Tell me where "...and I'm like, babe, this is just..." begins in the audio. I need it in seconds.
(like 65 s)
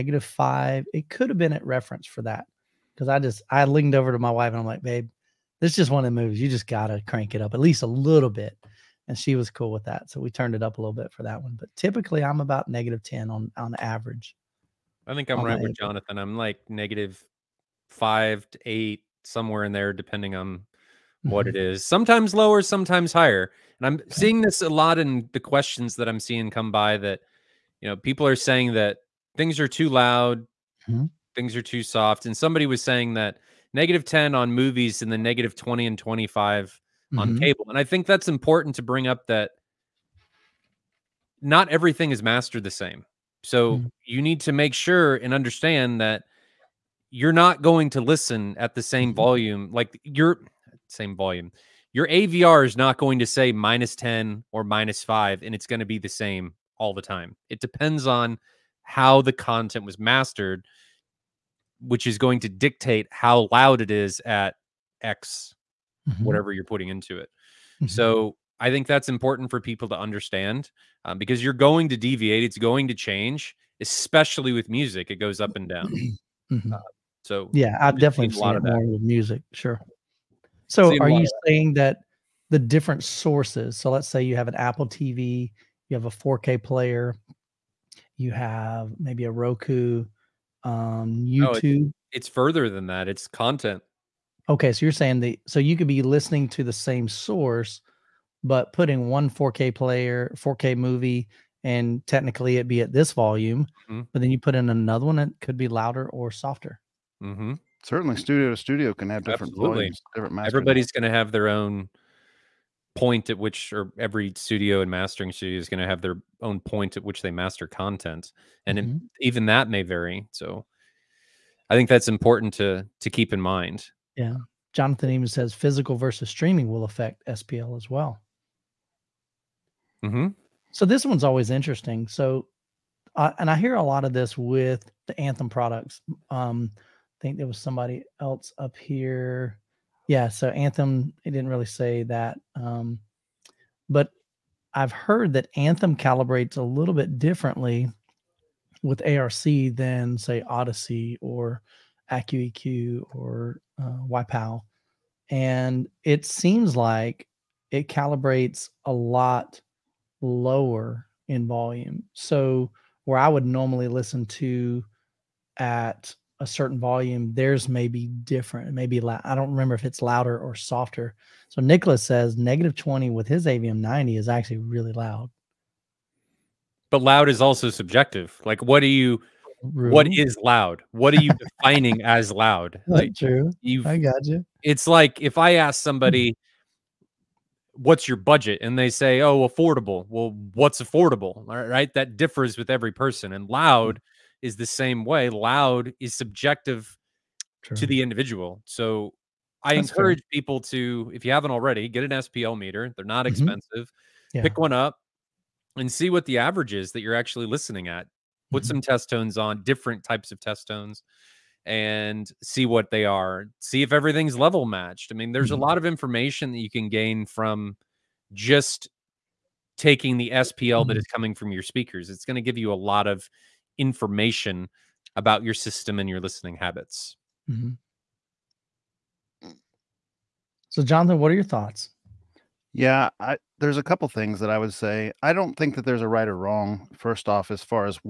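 4 s.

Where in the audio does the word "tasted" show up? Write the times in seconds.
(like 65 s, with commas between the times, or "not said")
not said.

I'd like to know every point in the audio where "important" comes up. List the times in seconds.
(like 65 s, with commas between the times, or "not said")
38 s, 69 s, 122 s.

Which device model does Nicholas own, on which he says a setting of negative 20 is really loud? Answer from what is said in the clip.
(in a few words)
AVM 90.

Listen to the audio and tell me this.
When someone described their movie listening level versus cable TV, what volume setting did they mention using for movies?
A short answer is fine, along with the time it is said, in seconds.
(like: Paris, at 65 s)
-10, at 33 s.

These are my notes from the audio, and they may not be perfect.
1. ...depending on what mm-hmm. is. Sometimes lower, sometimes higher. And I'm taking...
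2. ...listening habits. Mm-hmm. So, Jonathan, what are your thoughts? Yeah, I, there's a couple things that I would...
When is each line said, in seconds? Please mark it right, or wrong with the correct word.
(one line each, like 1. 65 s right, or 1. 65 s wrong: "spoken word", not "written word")
1. 19 s wrong: "seeing", not "taking"
2. 226 s right.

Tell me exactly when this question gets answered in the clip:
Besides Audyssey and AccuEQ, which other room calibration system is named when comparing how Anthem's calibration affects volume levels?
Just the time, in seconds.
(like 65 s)
154 s.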